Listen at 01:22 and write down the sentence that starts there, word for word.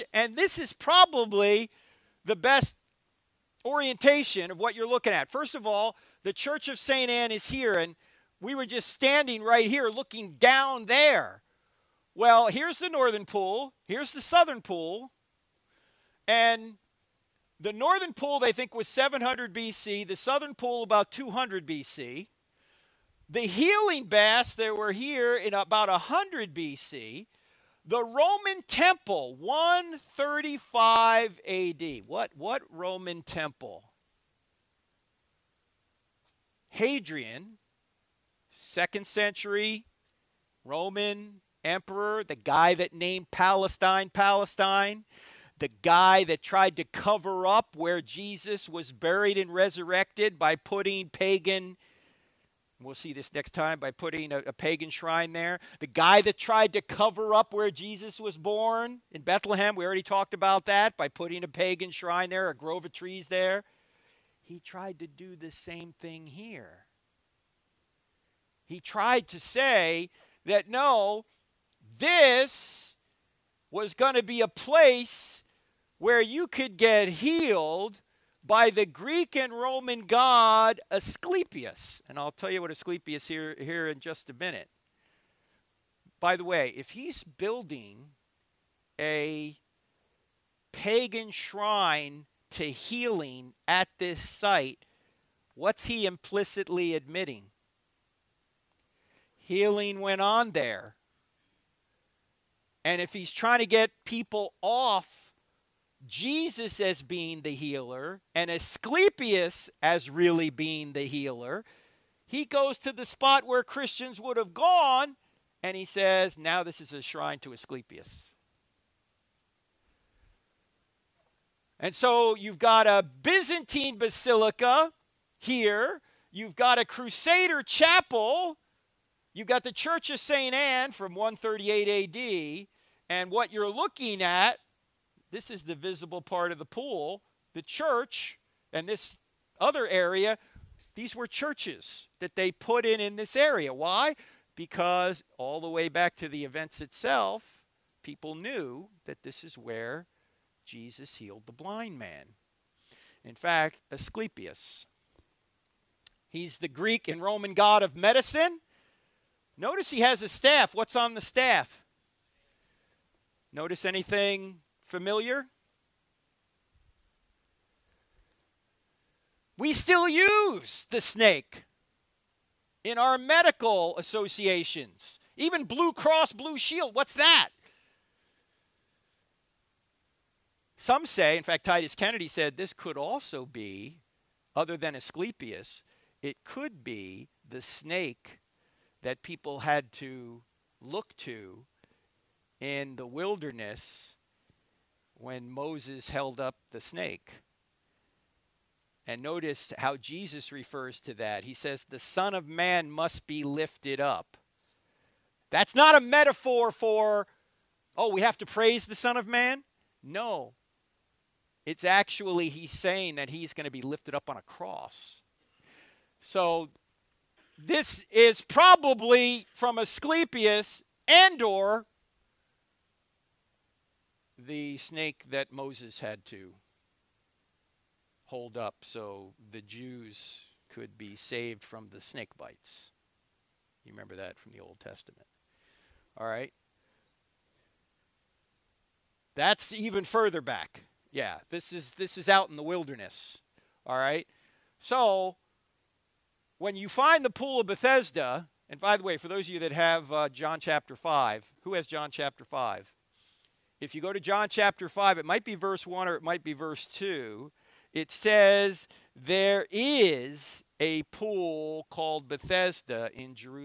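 And I'll tell you what Asclepius here here in just a minute.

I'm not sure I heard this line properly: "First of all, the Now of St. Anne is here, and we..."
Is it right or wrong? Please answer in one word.
wrong.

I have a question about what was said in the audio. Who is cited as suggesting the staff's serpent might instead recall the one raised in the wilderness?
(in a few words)
Titus Kennedy.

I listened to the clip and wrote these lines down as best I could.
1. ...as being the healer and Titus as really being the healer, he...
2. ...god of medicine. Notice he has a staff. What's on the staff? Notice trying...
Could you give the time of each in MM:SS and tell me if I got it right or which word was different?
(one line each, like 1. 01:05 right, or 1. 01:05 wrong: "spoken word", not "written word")
1. 01:46 wrong: "Asclepius", not "Titus"
2. 02:37 wrong: "anything", not "trying".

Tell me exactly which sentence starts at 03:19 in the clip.
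And notice how Jesus refers to that.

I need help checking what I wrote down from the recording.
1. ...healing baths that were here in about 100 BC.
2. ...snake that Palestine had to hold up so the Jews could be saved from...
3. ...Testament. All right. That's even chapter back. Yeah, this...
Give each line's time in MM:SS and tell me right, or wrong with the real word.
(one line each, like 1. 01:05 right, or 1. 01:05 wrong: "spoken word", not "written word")
1. 00:23 right
2. 03:44 wrong: "Moses", not "Palestine"
3. 03:54 wrong: "further", not "chapter".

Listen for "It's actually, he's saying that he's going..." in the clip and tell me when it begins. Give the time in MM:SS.
03:31.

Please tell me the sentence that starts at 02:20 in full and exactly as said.
These were churches that they put in in this area.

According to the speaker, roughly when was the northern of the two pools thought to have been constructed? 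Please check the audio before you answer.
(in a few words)
700 BC.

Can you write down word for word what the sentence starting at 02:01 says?
And so you've got a Byzantine basilica here, you've got a Crusader chapel, you've got the Church of St.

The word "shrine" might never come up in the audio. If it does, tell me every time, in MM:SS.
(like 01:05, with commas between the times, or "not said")
00:54, 01:01, 01:31, 01:57.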